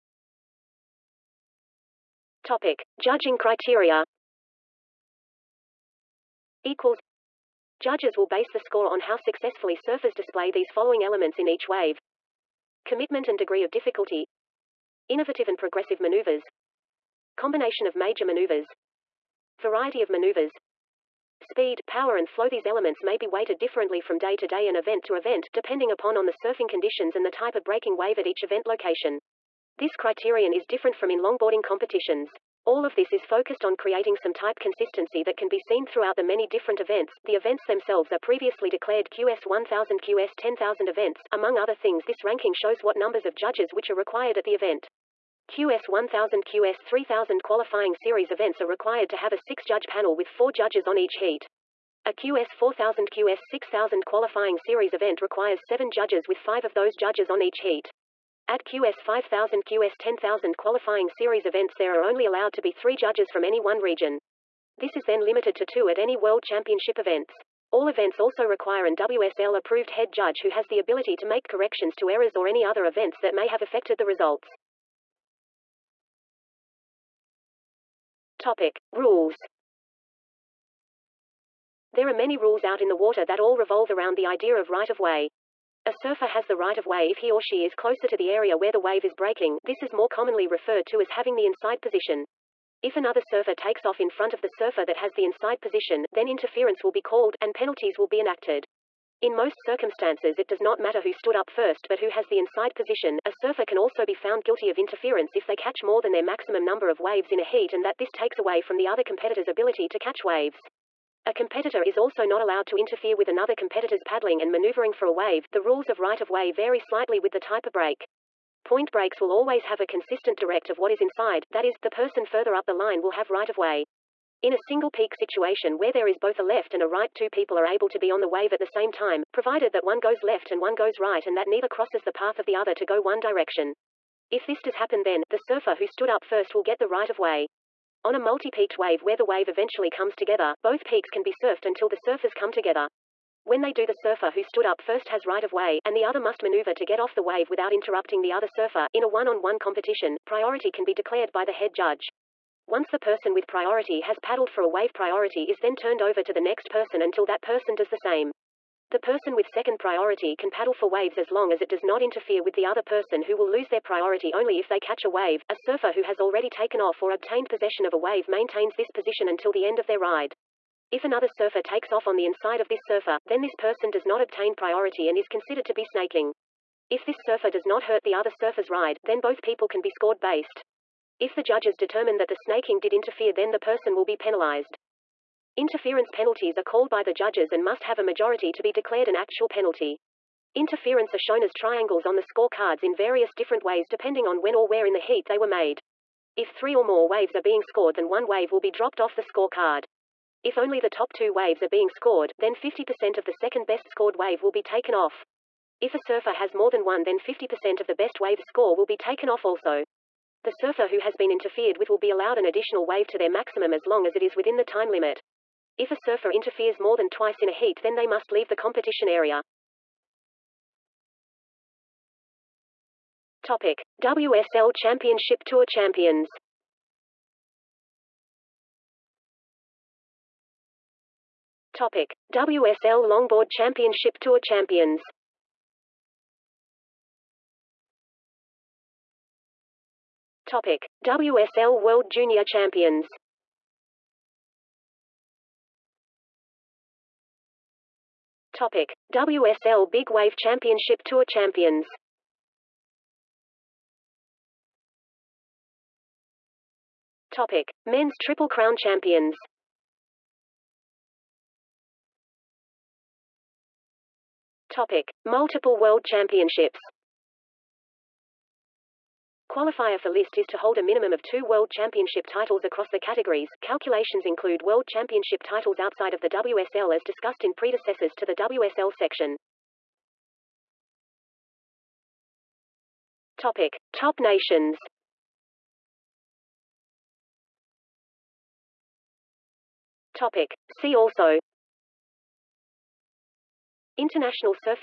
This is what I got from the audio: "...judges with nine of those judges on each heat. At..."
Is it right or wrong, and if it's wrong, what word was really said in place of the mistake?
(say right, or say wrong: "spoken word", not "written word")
wrong: "five", not "nine".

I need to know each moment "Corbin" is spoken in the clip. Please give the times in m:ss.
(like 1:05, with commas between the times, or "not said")
not said.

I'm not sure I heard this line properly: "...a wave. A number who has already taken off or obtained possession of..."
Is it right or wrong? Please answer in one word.
wrong.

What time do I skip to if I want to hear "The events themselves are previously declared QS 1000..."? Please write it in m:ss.
0:37.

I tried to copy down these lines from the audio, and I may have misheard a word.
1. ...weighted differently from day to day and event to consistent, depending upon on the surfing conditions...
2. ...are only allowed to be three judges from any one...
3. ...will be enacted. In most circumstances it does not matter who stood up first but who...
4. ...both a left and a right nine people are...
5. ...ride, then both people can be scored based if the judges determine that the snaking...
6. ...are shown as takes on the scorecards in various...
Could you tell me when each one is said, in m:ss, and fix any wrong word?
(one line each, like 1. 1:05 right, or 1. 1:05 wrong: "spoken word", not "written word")
1. 0:23 wrong: "event", not "consistent"
2. 1:01 right
3. 1:37 right
4. 2:06 wrong: "two", not "nine"
5. 2:58 right
6. 3:11 wrong: "triangles", not "takes".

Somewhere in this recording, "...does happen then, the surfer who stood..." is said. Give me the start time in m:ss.
2:14.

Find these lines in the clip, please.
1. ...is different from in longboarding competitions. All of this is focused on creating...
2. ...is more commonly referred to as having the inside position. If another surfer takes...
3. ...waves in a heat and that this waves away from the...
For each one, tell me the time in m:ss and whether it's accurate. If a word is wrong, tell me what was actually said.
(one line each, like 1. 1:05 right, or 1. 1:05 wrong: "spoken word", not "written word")
1. 0:30 right
2. 1:29 right
3. 1:46 wrong: "takes", not "waves".